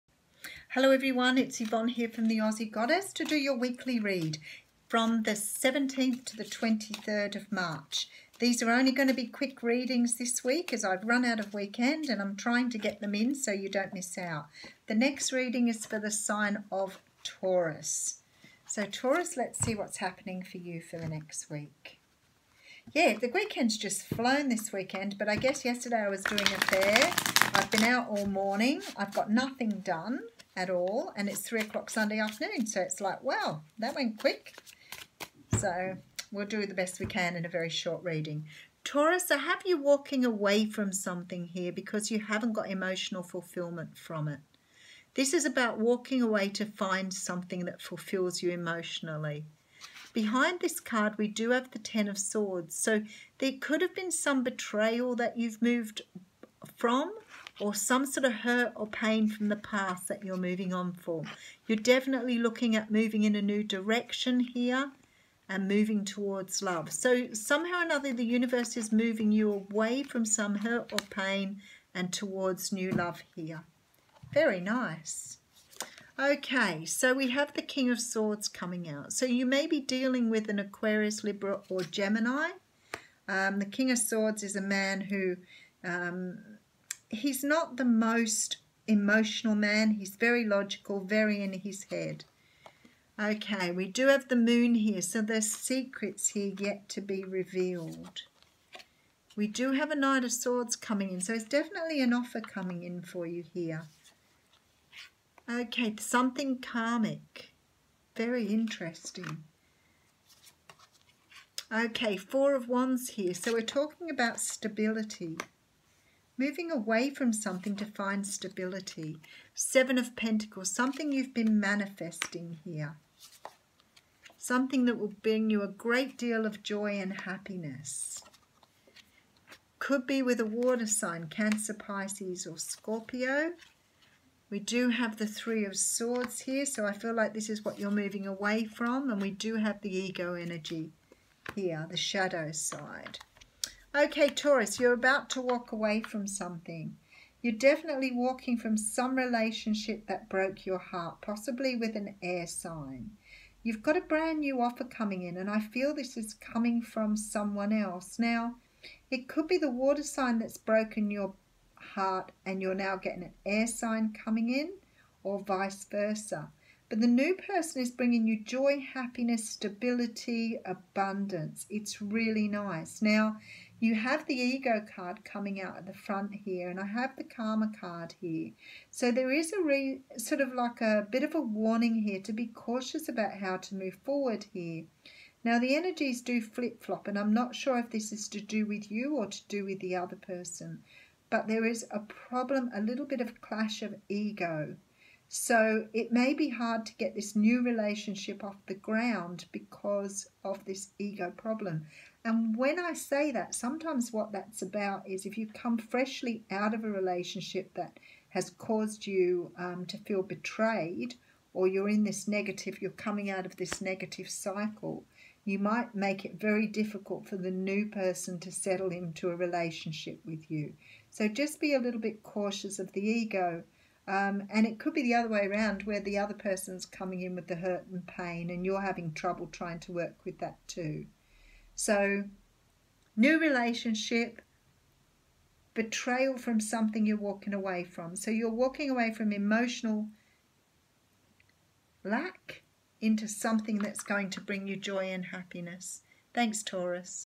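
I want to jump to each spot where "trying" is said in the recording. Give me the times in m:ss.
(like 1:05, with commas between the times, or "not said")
0:12, 3:49.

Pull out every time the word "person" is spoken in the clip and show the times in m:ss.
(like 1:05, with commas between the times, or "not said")
2:47, 3:10, 3:37, 3:46.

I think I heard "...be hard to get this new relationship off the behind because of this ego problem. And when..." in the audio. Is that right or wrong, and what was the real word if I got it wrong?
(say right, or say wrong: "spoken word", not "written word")
wrong: "ground", not "behind".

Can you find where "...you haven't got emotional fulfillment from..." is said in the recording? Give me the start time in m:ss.
0:42.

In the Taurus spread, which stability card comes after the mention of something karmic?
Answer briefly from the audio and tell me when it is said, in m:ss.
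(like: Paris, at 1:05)
Four of Wands, at 1:52.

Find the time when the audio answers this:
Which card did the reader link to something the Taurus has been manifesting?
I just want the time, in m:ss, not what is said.
1:59.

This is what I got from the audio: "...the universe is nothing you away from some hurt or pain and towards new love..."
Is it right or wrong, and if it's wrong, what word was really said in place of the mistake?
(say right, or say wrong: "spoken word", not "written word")
wrong: "moving", not "nothing".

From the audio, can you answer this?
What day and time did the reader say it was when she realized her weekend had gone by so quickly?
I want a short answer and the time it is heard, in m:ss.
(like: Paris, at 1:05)
3 o'clock Sunday afternoon, at 0:31.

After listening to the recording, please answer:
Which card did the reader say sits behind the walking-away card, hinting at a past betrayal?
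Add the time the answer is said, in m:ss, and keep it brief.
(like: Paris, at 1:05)
Ten of Swords, at 0:51.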